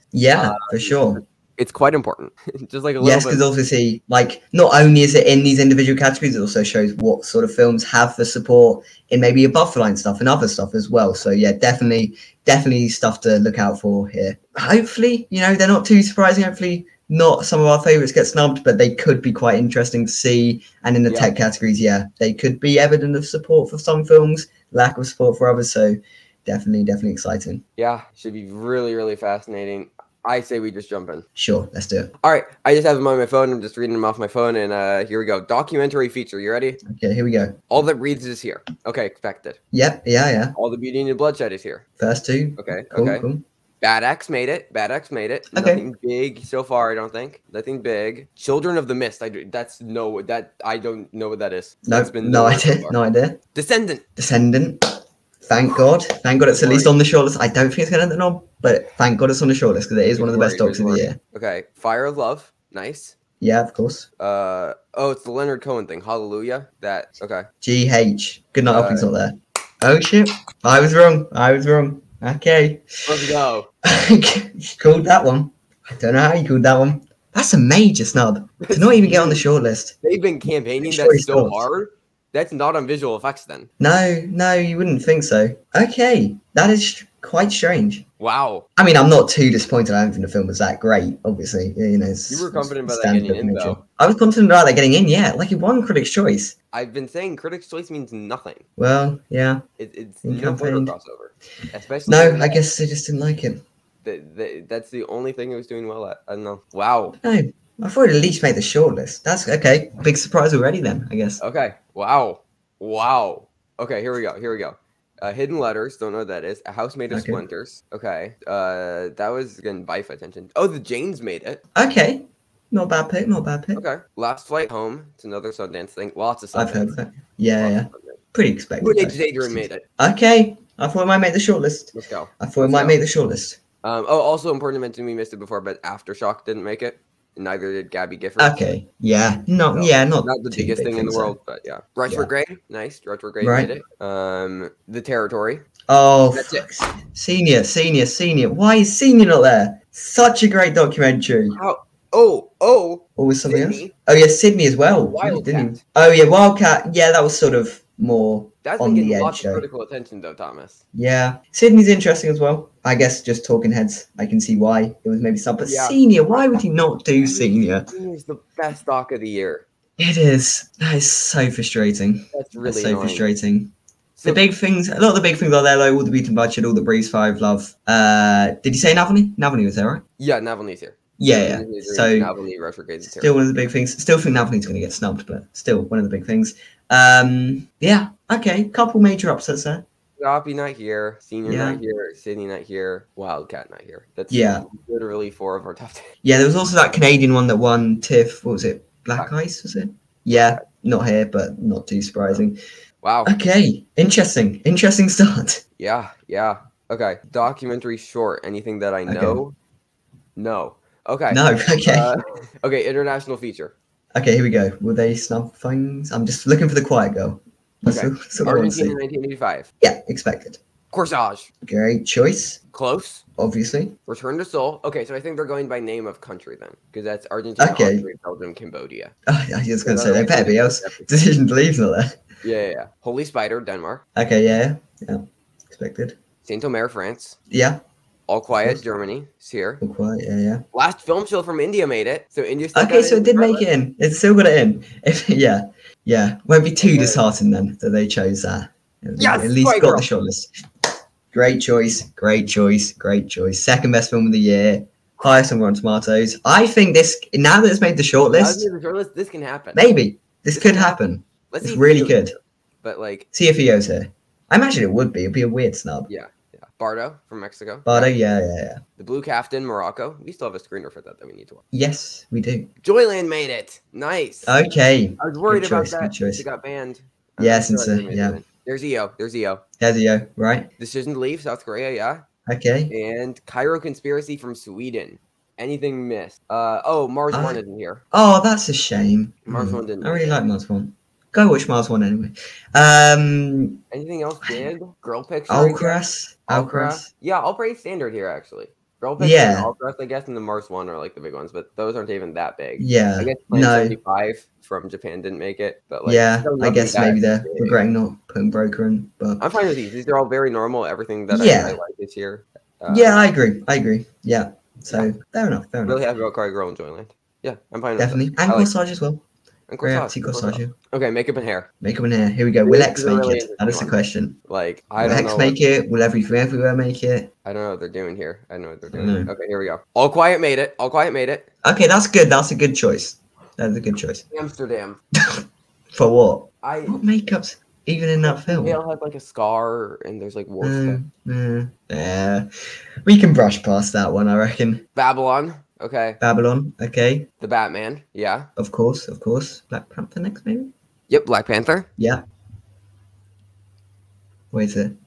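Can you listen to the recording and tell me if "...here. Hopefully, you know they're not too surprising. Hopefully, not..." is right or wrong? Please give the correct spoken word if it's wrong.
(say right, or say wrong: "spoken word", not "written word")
right.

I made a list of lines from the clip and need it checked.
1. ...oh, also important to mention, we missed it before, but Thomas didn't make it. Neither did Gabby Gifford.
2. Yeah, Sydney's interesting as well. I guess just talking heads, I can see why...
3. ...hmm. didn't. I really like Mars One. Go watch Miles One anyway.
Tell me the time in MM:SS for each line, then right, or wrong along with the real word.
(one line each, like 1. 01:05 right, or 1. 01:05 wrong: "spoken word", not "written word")
1. 02:14 wrong: "Aftershock", not "Thomas"
2. 02:40 right
3. 04:49 right.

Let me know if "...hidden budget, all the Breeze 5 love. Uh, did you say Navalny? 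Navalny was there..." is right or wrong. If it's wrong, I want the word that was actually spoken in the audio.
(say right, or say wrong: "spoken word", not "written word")
wrong: "beaten", not "hidden".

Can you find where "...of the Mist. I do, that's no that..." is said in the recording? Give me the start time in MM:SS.
00:48.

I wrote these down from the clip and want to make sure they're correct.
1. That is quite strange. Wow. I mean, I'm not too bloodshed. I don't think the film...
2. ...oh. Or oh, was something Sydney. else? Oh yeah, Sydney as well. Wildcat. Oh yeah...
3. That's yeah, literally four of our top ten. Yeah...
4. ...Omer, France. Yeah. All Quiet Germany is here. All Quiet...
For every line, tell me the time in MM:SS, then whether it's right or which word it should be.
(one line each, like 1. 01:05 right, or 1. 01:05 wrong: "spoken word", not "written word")
1. 01:26 wrong: "disappointed", not "bloodshed"
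2. 02:32 right
3. 03:14 right
4. 03:56 right.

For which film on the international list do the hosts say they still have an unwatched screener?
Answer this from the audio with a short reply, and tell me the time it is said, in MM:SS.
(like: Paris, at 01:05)
The Blue Caftan, at 04:28.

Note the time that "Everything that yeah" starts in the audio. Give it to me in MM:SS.
05:10.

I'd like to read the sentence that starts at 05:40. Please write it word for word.
Mm, mm, yeah, we can brush past that one, I reckon.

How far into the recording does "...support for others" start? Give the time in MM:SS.
00:25.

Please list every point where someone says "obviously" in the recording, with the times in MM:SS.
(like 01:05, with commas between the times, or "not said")
00:03, 01:31, 03:43.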